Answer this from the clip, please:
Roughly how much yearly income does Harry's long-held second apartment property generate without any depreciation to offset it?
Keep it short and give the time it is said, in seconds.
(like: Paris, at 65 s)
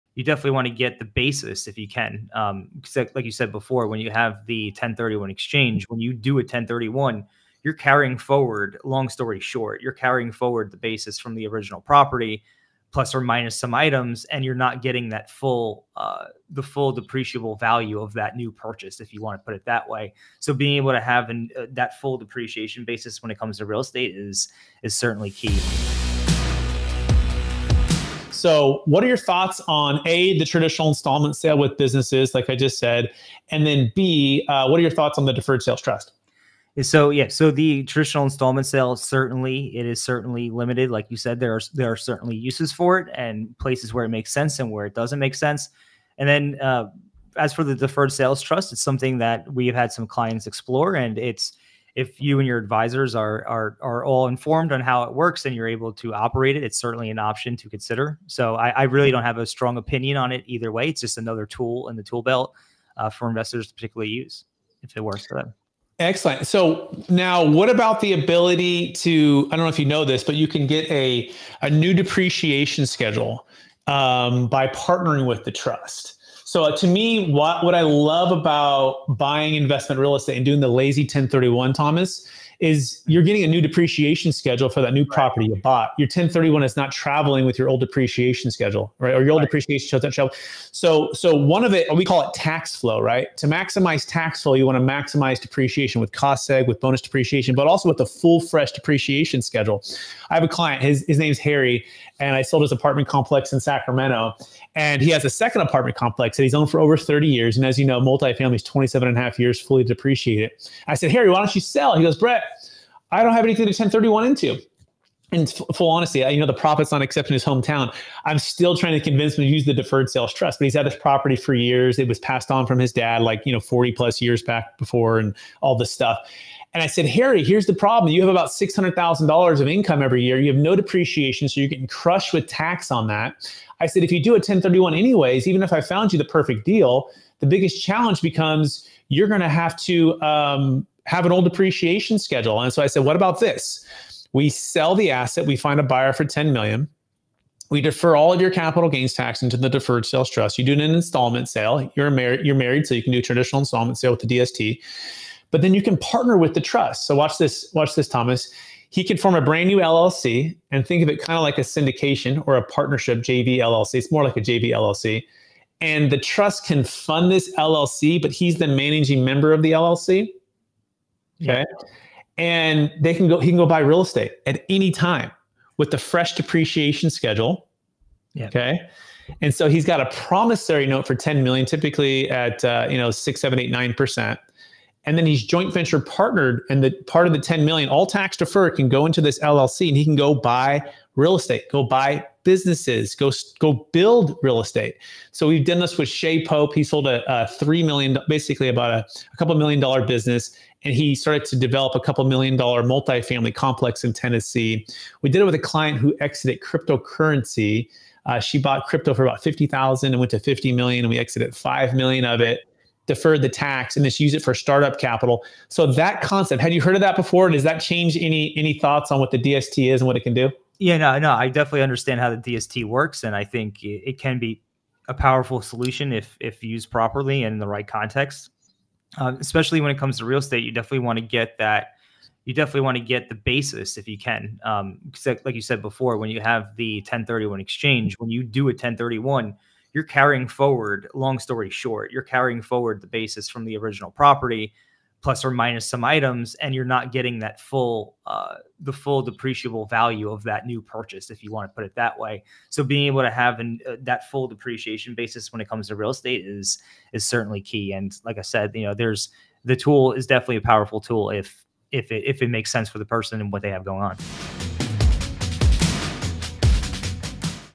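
$600,000, at 128 s.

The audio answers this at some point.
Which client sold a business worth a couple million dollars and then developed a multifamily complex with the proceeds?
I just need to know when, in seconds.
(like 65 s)
196 s.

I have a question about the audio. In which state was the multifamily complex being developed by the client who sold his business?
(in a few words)
Tennessee.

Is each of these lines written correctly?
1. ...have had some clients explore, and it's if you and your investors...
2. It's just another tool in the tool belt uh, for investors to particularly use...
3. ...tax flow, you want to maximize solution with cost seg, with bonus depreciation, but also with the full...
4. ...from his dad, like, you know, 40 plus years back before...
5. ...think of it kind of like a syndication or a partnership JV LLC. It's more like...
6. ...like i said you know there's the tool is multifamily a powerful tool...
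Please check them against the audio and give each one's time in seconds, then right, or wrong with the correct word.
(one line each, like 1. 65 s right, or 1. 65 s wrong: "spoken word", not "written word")
1. 49 s wrong: "advisors", not "investors"
2. 60 s right
3. 94 s wrong: "depreciation", not "solution"
4. 122 s right
5. 160 s right
6. 258 s wrong: "definitely", not "multifamily".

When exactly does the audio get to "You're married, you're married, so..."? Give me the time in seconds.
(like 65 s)
151 s.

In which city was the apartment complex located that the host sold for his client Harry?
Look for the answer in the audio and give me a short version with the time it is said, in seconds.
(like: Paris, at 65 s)
Sacramento, at 103 s.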